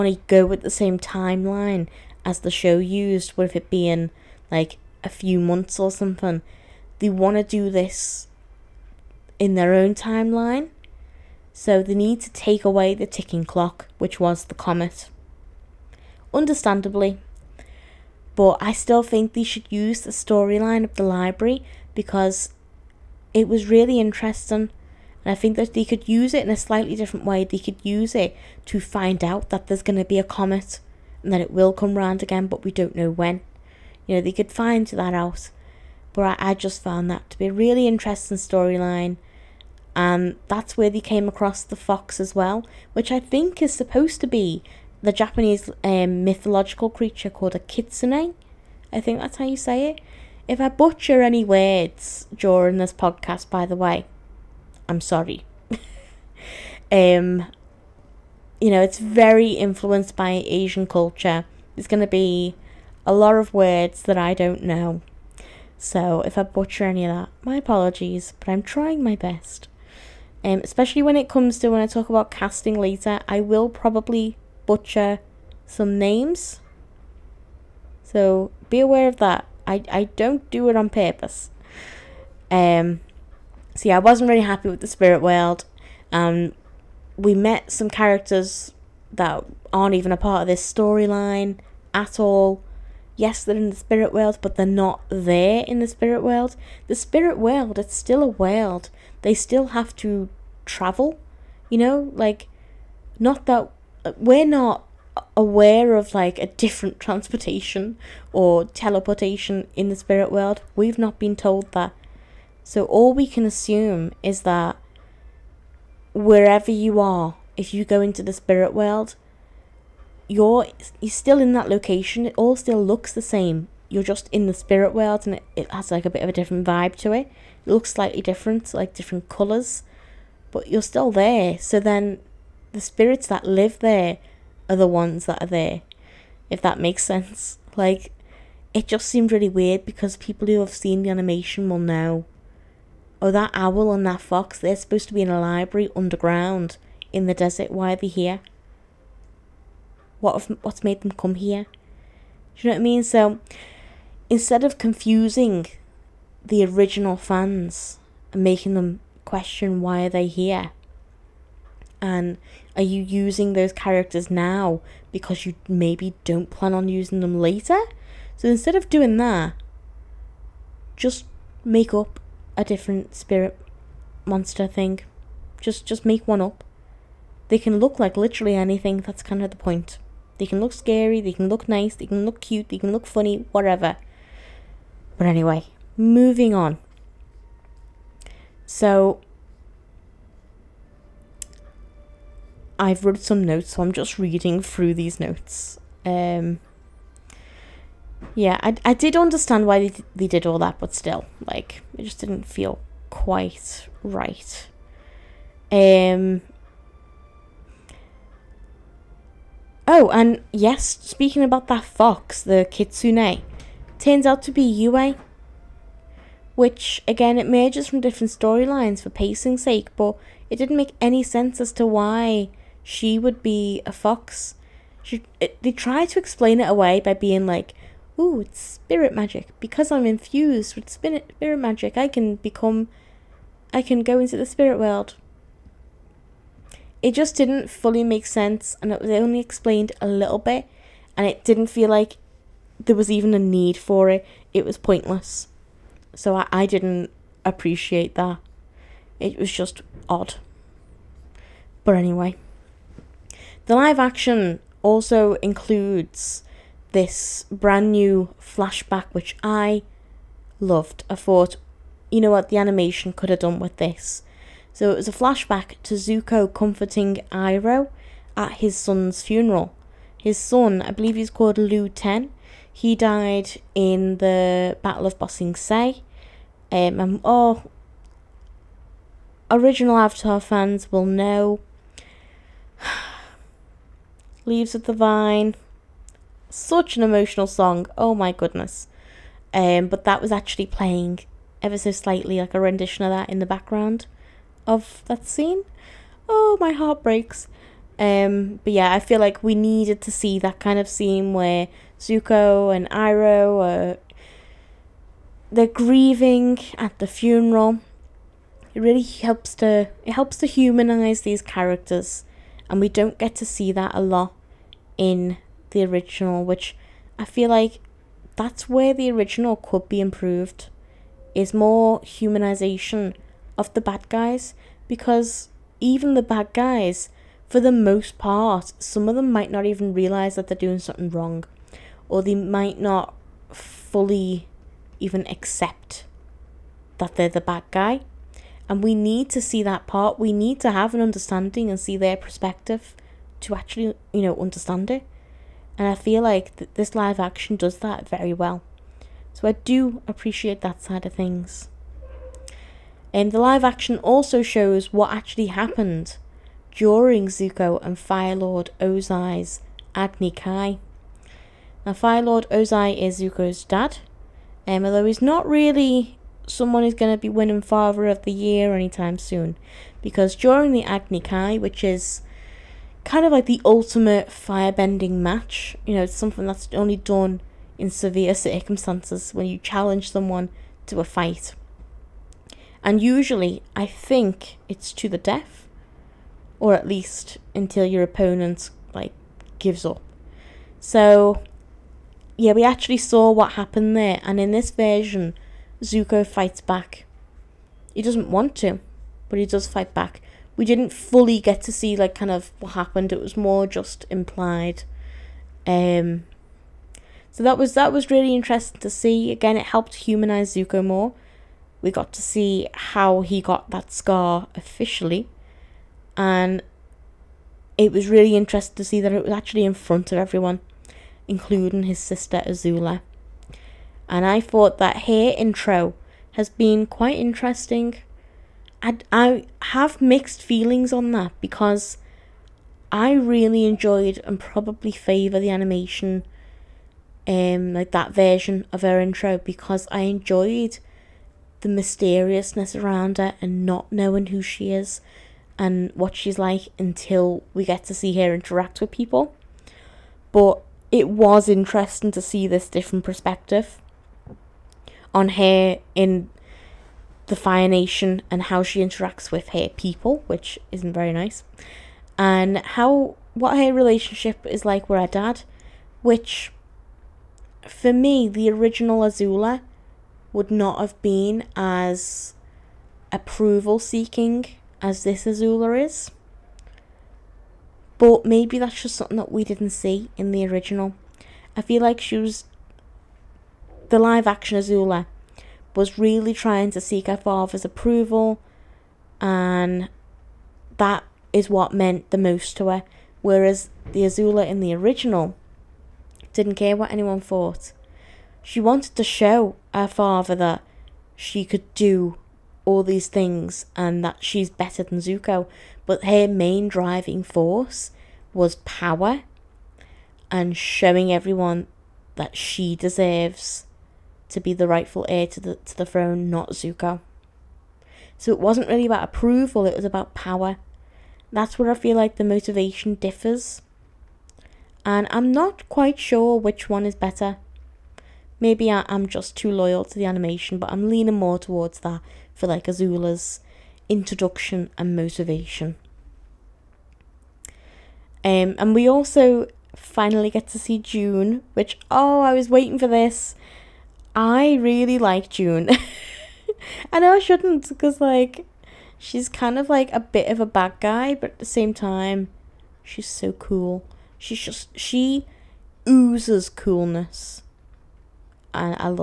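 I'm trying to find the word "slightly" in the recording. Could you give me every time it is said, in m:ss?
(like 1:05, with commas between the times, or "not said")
0:26, 2:07, 4:51.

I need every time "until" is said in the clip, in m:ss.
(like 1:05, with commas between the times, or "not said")
6:27, 7:26.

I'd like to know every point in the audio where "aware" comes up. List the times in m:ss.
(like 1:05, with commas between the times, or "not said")
1:18, 1:45.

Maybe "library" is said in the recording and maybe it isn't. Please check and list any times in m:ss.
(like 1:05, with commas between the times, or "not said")
0:21, 2:25.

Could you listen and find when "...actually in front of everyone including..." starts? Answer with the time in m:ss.
6:59.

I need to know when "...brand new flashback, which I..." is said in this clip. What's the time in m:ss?
4:17.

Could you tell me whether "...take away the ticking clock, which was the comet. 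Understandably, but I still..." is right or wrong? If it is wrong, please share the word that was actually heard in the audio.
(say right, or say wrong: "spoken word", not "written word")
right.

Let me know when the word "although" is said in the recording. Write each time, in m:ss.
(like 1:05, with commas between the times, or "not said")
6:04.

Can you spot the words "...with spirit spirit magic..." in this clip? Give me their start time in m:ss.
3:50.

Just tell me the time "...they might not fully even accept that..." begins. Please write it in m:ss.
5:32.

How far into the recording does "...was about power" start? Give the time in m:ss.
8:39.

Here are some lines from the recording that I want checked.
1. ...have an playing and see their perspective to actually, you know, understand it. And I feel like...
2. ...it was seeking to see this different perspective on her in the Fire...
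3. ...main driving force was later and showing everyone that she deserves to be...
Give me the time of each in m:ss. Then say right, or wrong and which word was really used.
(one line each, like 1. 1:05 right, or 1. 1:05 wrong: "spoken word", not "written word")
1. 5:40 wrong: "understanding", not "playing"
2. 7:30 wrong: "interesting", not "seeking"
3. 8:26 wrong: "power", not "later".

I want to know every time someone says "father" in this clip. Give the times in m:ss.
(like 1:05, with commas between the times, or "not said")
6:07, 8:07, 8:19.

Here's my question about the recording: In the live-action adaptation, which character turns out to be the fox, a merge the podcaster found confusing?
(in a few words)
Yue.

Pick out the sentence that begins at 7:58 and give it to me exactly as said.
But maybe that's just something that we didn't see in the original.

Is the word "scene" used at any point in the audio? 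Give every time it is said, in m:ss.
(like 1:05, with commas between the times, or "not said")
4:55, 5:00.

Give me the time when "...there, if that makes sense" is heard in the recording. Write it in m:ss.
2:15.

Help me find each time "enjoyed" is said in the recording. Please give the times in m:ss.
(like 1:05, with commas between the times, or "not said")
7:13, 7:20.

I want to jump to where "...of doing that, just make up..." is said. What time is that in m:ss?
2:48.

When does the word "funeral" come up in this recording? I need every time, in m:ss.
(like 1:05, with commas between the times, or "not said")
4:29, 5:07.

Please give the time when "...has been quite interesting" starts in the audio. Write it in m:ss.
7:06.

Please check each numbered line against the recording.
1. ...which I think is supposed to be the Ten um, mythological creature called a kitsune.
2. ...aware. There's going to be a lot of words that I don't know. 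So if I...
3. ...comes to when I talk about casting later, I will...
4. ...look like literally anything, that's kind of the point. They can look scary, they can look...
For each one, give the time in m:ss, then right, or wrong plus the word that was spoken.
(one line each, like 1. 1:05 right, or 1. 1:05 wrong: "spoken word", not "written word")
1. 0:42 wrong: "Japanese", not "Ten"
2. 1:00 wrong: "culture", not "aware"
3. 1:11 right
4. 2:57 right.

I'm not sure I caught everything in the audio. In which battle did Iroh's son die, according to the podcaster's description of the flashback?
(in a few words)
Battle of Ba Sing Se.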